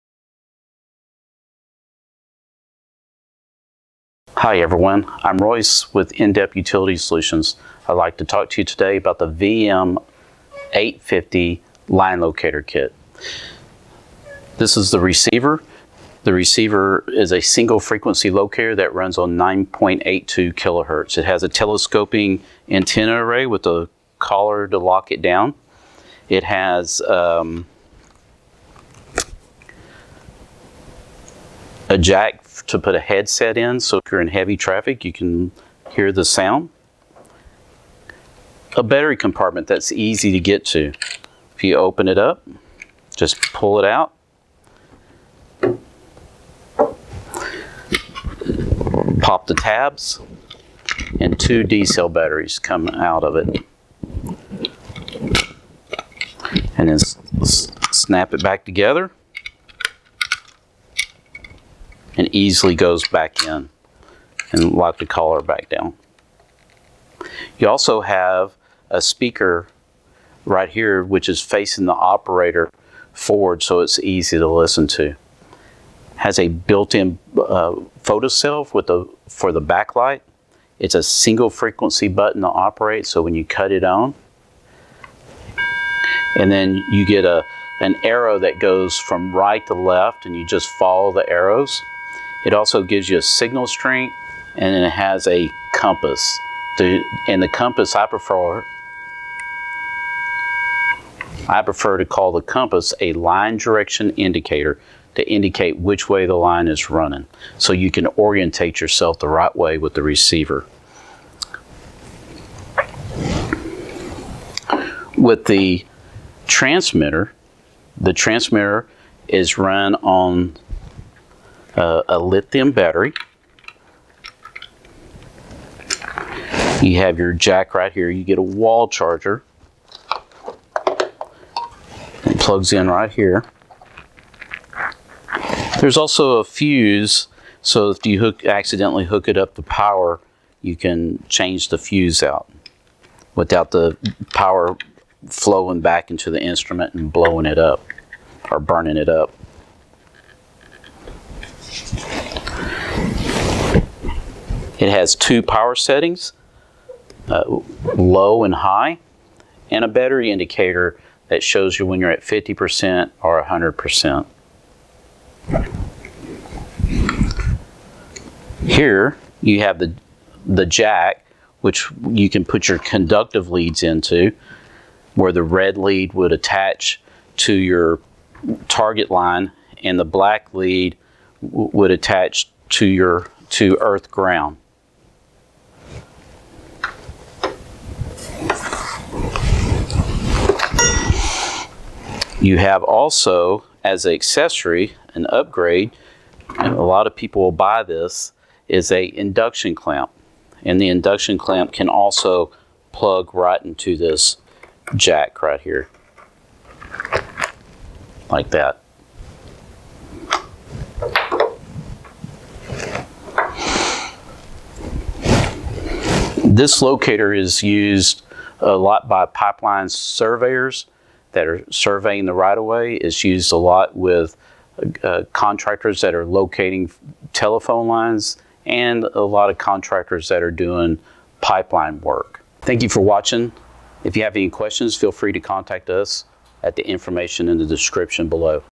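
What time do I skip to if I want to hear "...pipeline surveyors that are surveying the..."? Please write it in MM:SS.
03:39.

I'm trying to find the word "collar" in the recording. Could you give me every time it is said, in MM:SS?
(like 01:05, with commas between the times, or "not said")
00:24, 01:05.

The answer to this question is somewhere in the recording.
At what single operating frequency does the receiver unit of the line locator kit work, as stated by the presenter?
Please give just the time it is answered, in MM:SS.
00:19.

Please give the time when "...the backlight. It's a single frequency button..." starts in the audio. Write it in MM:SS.
01:19.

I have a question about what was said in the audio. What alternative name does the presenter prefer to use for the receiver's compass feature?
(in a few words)
line direction indicator.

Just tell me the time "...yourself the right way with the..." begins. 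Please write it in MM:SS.
01:48.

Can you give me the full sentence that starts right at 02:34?
It has two power settings, uh, low and high, and a battery indicator that shows you when you're at 50% or 100%.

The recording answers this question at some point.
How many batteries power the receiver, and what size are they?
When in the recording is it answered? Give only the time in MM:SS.
00:51.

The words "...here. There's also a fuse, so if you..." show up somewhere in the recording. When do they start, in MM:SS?
02:13.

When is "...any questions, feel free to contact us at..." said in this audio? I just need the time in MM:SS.
03:54.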